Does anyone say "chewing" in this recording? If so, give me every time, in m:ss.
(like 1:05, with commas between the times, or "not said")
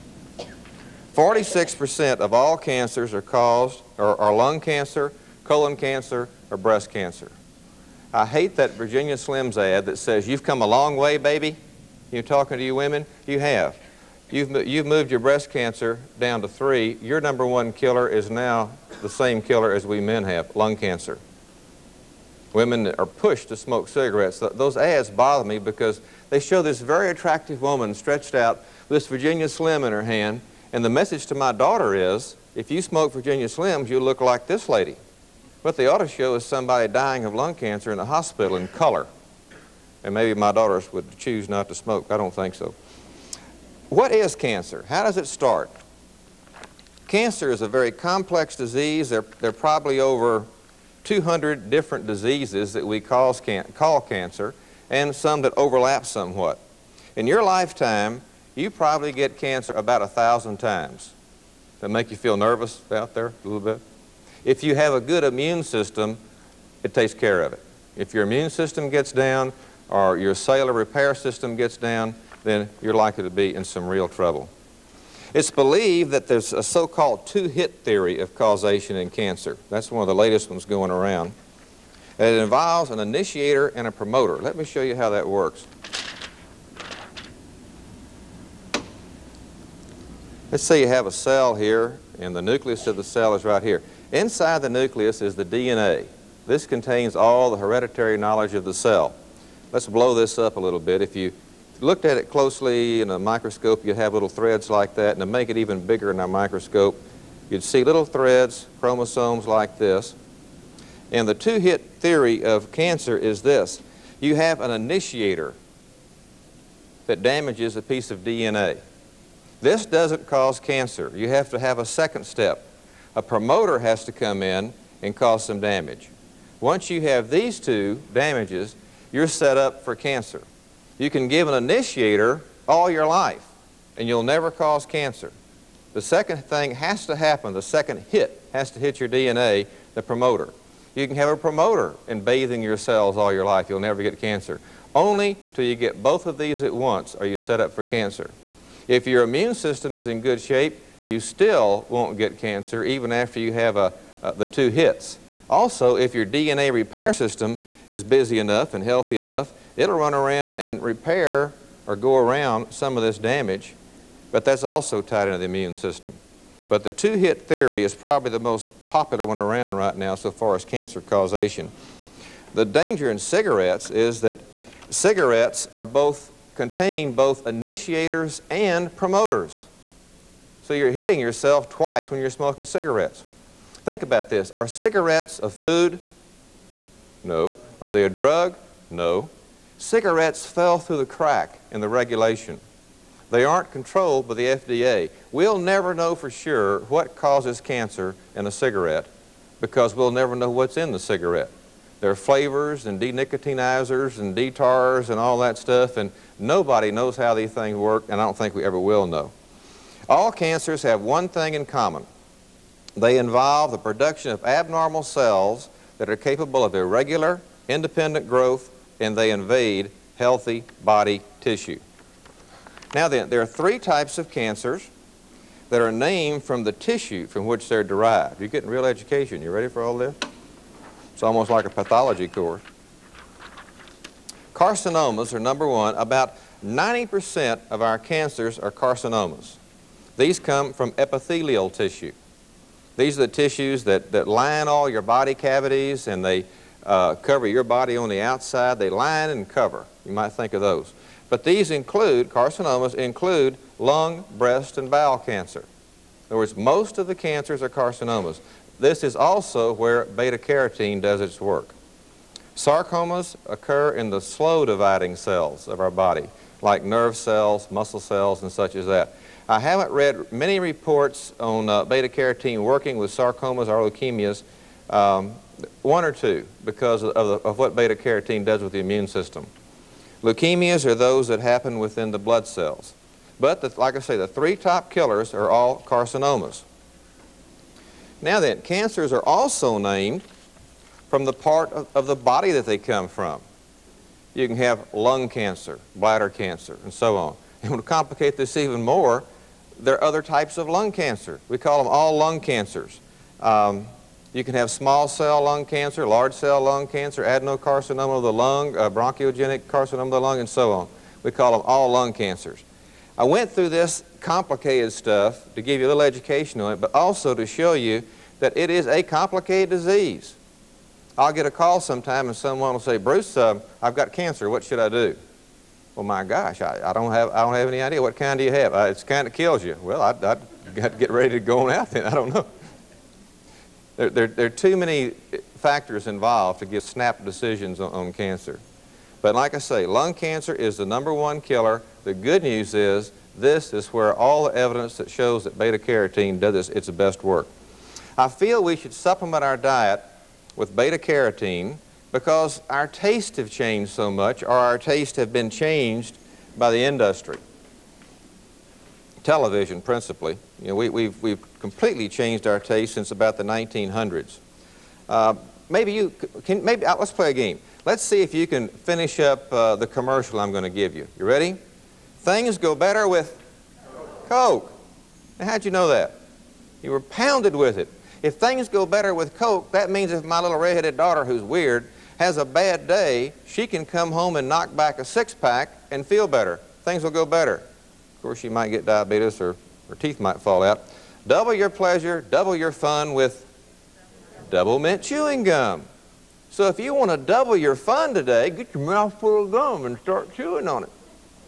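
6:35, 6:40.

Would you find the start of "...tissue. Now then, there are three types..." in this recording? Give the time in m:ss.
3:41.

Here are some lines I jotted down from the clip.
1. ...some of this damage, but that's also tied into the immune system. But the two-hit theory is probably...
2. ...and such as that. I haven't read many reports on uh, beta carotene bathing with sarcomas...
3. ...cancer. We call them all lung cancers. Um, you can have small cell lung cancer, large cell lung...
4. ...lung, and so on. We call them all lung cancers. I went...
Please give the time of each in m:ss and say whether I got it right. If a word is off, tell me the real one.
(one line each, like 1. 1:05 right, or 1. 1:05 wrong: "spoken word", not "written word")
1. 2:42 right
2. 4:28 wrong: "working", not "bathing"
3. 5:00 right
4. 5:10 right.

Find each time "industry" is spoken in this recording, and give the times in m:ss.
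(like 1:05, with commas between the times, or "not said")
5:56.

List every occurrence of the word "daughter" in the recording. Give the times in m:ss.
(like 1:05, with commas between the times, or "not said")
0:31, 0:40, 6:20.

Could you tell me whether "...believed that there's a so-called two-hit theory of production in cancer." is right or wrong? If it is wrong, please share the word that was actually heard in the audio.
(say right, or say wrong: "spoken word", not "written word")
wrong: "causation", not "production".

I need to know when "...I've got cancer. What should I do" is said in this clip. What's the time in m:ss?
5:23.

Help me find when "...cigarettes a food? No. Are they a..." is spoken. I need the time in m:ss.
3:04.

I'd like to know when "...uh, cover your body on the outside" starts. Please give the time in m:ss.
4:06.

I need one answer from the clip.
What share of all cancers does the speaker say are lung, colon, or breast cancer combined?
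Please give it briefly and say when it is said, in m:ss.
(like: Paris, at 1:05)
46%, at 0:01.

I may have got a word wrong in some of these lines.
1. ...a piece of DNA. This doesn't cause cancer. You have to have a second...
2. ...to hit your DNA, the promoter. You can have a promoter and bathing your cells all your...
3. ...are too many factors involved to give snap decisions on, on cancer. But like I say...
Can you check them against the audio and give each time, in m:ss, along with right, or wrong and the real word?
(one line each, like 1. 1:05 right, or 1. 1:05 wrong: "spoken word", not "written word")
1. 1:57 right
2. 2:18 right
3. 5:34 right.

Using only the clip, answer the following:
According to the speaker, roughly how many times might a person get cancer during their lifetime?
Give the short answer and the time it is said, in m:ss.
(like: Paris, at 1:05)
1000, at 1:00.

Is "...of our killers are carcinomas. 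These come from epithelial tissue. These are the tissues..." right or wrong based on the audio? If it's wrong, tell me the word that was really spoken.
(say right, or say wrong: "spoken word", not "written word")
wrong: "cancers", not "killers".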